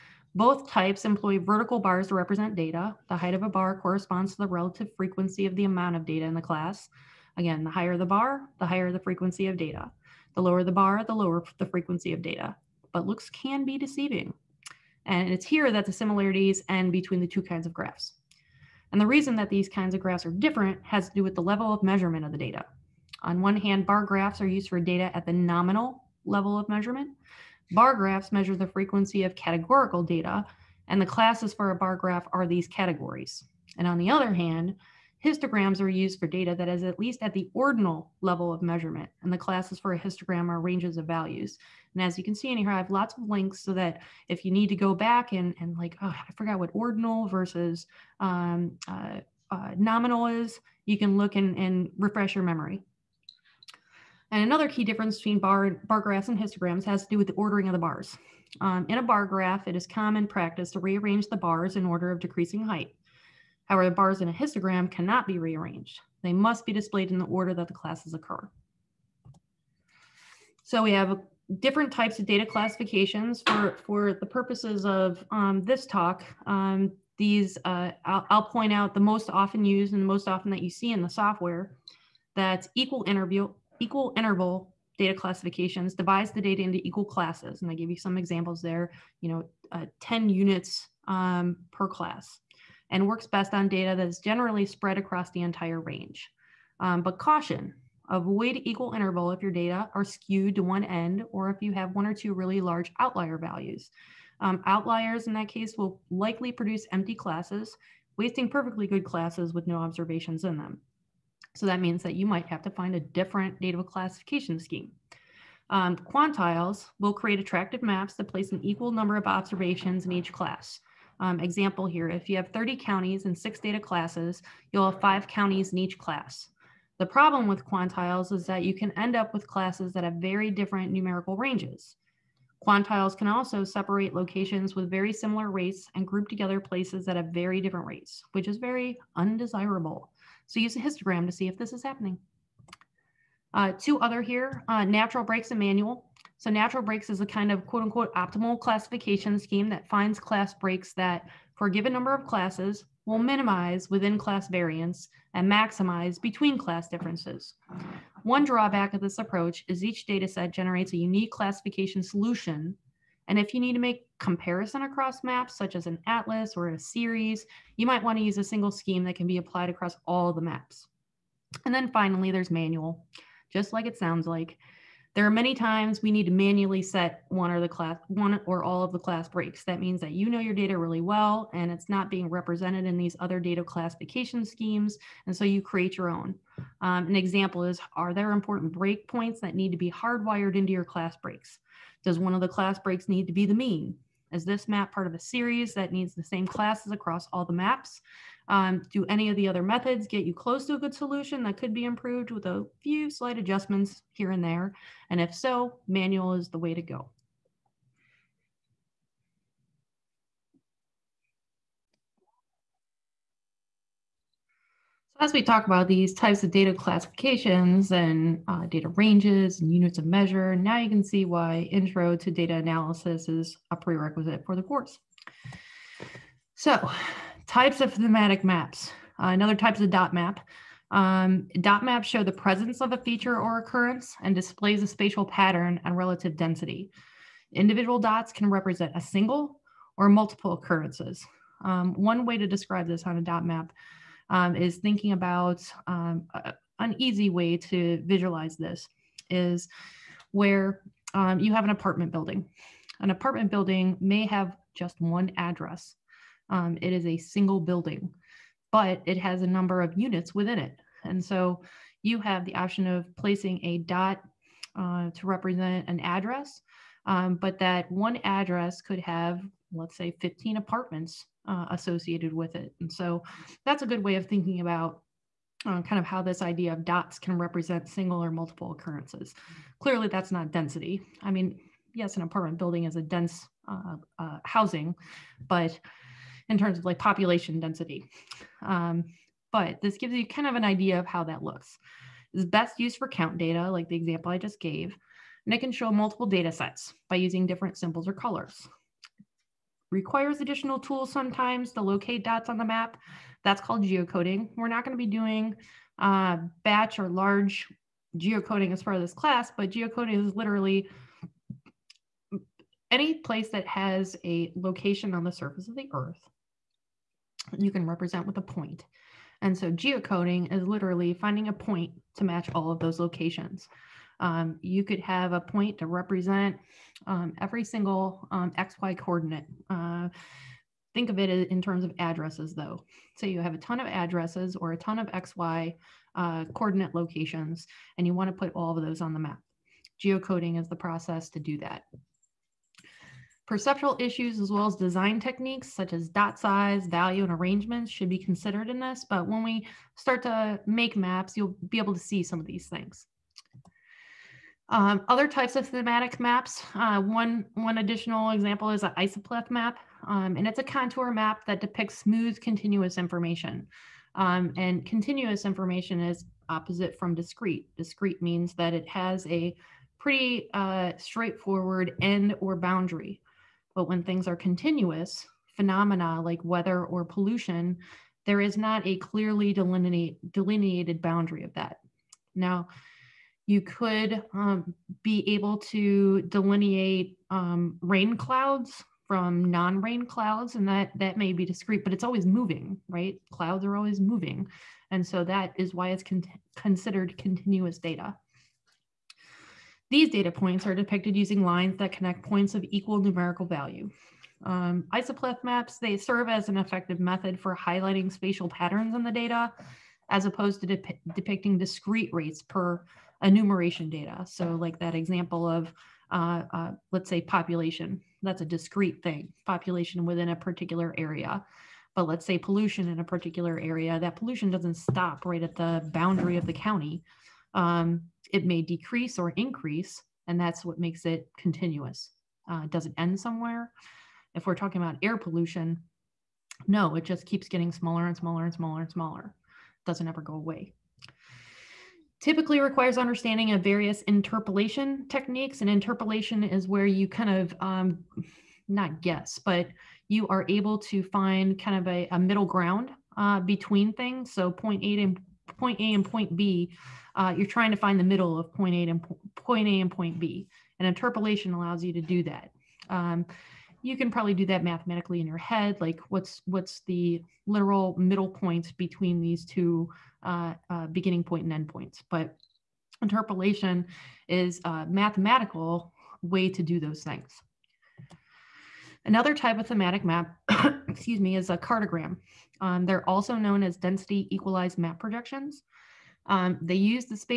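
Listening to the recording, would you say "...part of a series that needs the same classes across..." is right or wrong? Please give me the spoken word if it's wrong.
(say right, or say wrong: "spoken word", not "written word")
right.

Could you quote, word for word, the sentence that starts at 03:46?
So types of thematic maps, uh, another types of dot map.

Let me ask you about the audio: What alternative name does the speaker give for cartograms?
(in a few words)
Density equalized map projections.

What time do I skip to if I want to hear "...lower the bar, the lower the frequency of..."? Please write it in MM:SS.
00:10.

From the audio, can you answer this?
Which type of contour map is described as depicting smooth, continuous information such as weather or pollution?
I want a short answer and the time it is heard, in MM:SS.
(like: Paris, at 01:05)
Isopleth map, at 05:58.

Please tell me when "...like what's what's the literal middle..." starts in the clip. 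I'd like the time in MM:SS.
07:45.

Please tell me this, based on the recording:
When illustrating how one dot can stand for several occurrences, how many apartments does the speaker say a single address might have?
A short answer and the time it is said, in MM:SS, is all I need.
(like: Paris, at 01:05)
15, at 04:30.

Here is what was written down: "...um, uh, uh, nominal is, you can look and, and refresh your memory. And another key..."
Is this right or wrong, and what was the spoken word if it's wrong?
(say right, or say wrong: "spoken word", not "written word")
right.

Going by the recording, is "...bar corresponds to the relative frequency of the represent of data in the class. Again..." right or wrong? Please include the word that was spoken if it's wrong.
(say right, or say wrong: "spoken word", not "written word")
wrong: "amount", not "represent".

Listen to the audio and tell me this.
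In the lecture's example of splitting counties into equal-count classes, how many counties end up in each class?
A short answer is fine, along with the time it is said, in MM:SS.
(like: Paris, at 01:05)
5, at 02:05.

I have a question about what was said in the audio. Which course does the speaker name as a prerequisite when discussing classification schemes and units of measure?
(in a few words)
Intro to data analysis.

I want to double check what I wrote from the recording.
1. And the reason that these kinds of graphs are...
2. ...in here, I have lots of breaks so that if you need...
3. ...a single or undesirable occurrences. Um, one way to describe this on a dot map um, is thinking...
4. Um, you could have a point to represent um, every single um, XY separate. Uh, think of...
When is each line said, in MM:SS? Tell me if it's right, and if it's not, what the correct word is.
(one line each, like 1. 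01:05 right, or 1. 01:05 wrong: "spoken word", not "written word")
1. 00:18 right
2. 00:42 wrong: "links", not "breaks"
3. 03:58 wrong: "multiple", not "undesirable"
4. 05:24 wrong: "coordinate", not "separate".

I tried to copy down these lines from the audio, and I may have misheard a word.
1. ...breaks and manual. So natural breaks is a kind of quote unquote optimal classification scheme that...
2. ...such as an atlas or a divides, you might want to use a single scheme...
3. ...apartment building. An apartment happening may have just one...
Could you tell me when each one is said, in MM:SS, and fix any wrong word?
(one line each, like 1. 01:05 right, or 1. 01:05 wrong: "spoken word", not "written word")
1. 02:25 right
2. 02:45 wrong: "series", not "divides"
3. 04:11 wrong: "building", not "happening".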